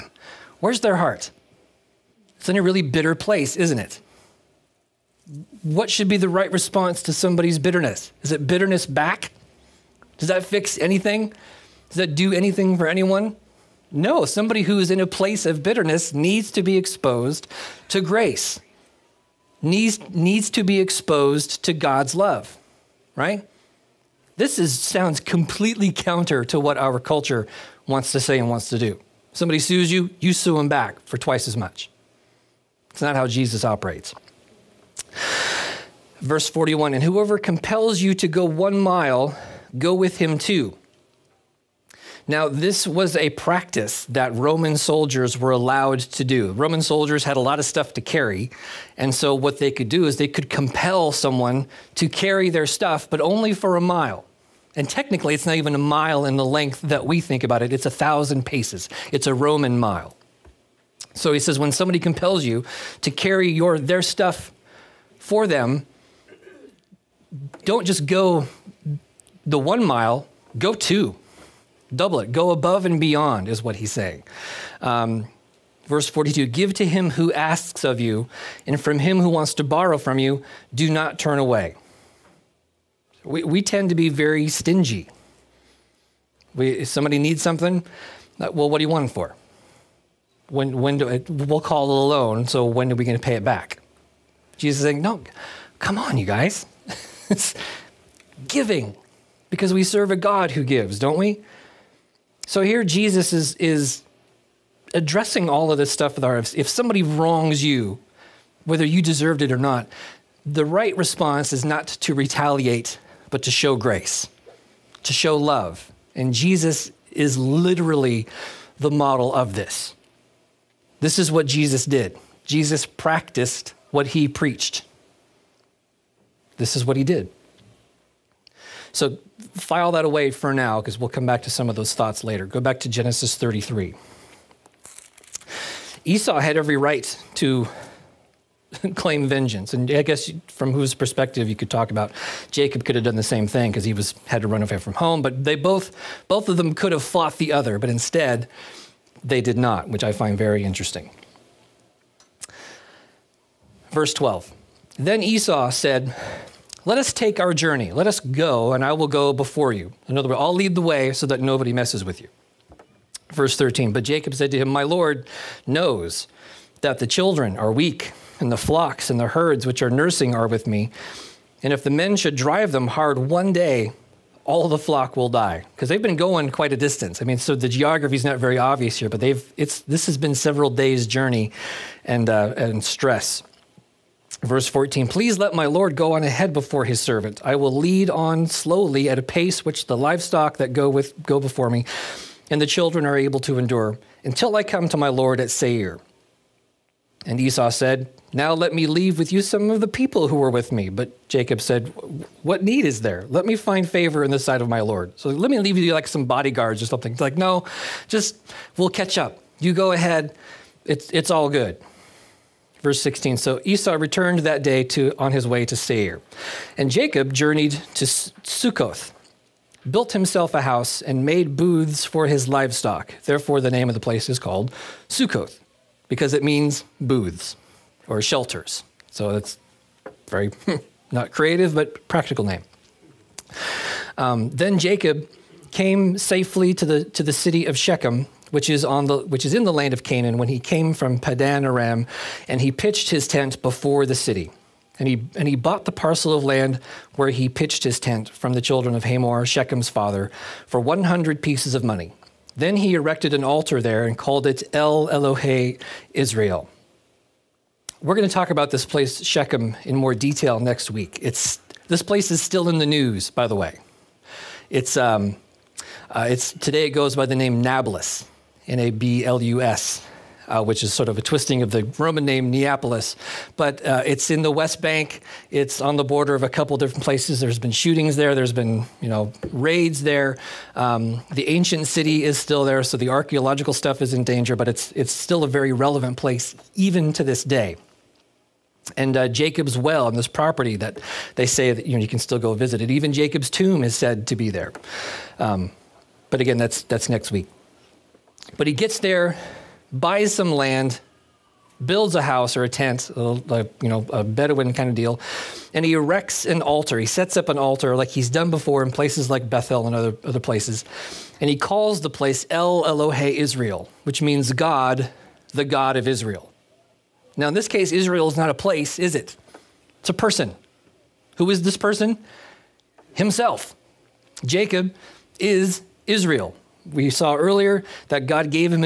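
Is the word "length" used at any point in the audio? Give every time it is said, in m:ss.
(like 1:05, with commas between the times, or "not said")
0:56.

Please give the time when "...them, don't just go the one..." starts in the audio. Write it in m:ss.
1:05.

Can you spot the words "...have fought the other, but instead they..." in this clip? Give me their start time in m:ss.
2:26.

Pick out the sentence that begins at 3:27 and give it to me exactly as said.
It's like, no, just we'll catch up.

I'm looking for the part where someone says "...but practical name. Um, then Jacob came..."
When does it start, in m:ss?
3:51.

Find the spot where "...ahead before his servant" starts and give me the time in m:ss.
3:06.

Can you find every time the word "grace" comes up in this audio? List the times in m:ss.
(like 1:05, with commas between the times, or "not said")
0:17, 1:53.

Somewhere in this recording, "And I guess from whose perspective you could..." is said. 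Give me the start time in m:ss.
2:19.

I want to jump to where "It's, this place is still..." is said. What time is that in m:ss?
4:21.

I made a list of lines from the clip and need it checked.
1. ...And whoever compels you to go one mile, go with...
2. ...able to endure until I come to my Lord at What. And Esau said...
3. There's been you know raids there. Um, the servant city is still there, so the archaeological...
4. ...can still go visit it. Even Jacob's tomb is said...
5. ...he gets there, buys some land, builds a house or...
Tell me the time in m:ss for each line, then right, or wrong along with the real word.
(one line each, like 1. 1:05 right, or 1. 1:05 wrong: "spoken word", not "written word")
1. 0:36 right
2. 3:13 wrong: "Seir", not "What"
3. 4:38 wrong: "ancient", not "servant"
4. 4:52 right
5. 4:58 right.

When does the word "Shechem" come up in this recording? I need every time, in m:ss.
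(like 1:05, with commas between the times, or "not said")
3:57, 4:09, 4:19.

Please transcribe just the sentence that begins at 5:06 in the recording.
He sets up an altar like he's done before in places like Bethel and other, other places.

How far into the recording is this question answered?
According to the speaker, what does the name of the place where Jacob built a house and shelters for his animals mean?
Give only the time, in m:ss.
3:46.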